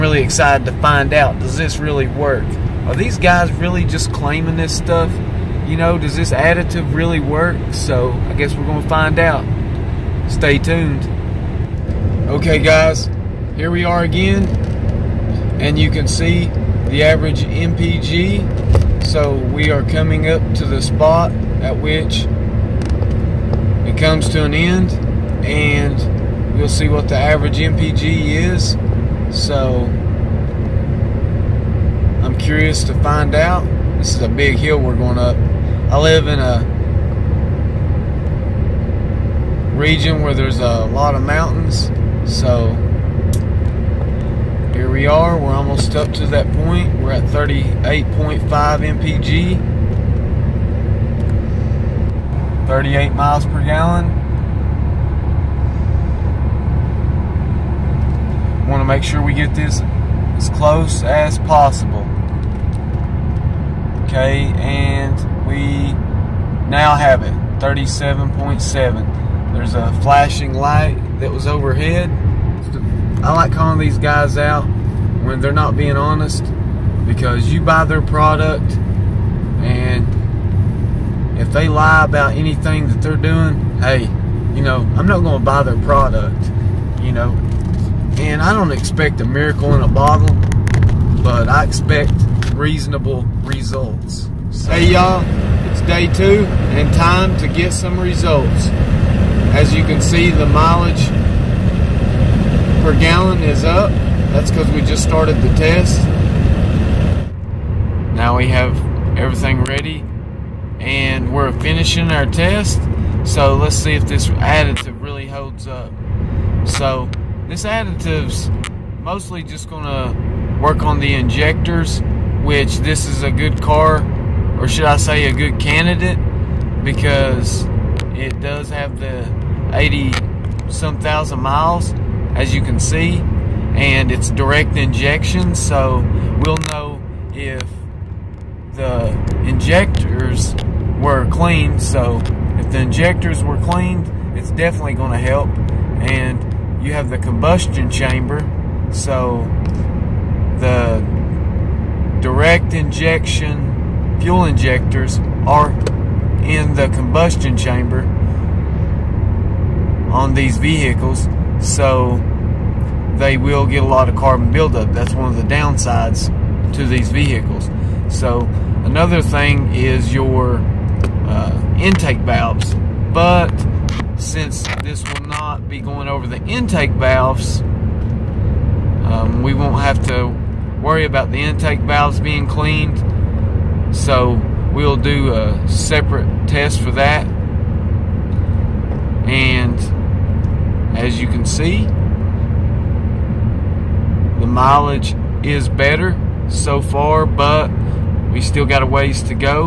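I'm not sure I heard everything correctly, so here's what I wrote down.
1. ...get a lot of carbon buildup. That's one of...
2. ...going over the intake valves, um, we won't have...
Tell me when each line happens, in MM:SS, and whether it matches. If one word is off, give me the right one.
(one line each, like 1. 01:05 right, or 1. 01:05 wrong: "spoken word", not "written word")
1. 02:43 right
2. 02:55 right.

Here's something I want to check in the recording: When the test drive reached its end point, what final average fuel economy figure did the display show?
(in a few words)
37.7.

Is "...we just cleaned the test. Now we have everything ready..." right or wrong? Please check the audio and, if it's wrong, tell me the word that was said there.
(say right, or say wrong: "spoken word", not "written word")
wrong: "started", not "cleaned".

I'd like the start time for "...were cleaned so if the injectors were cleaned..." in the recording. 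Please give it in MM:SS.
02:21.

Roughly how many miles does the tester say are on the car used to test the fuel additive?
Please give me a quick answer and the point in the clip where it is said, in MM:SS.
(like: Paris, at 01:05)
80 some thousand, at 02:09.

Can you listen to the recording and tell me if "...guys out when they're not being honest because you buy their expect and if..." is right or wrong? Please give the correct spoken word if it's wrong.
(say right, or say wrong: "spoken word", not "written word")
wrong: "product", not "expect".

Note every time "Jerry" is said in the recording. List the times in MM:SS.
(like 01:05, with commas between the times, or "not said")
not said.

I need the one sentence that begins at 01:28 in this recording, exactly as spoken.
And I don't expect a miracle in a bottle, but I expect reasonable results.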